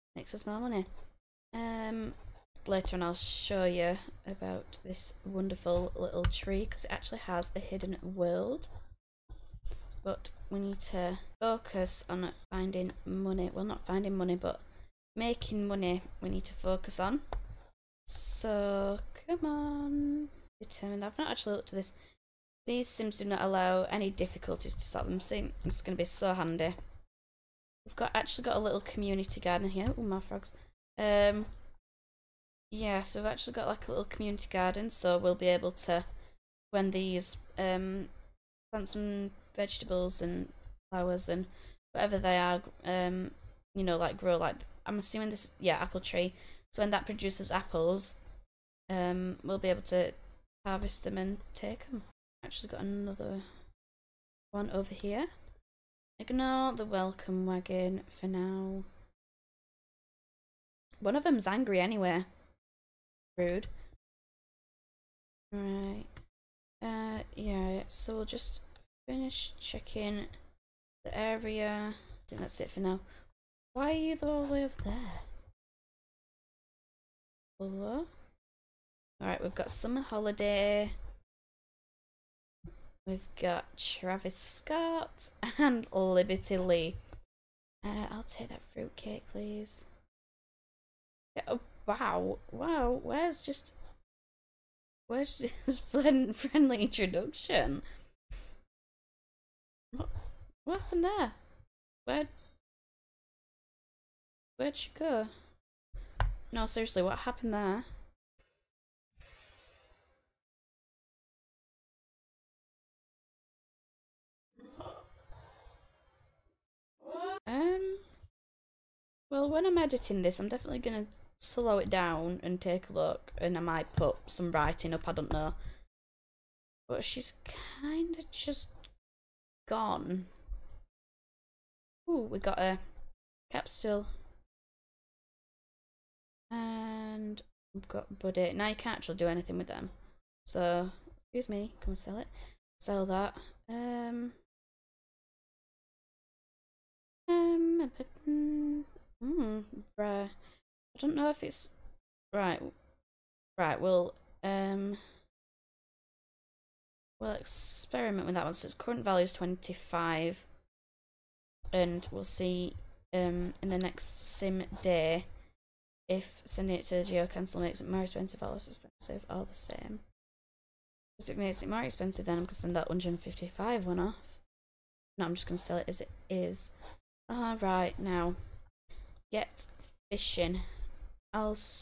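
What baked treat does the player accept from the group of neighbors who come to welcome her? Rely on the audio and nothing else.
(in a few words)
Fruitcake.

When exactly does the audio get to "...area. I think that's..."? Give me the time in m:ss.
1:11.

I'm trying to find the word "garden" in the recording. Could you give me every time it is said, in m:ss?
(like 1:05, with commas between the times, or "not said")
0:29, 0:34.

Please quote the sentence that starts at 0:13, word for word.
Well, not finding money, but making money we need to focus on.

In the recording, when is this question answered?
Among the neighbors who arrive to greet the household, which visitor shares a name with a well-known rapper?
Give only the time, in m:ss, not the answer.
1:23.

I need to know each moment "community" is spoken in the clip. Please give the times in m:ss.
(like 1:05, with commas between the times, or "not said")
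0:28, 0:34.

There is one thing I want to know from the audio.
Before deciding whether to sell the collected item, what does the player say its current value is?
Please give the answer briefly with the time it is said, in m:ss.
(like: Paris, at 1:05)
25, at 2:39.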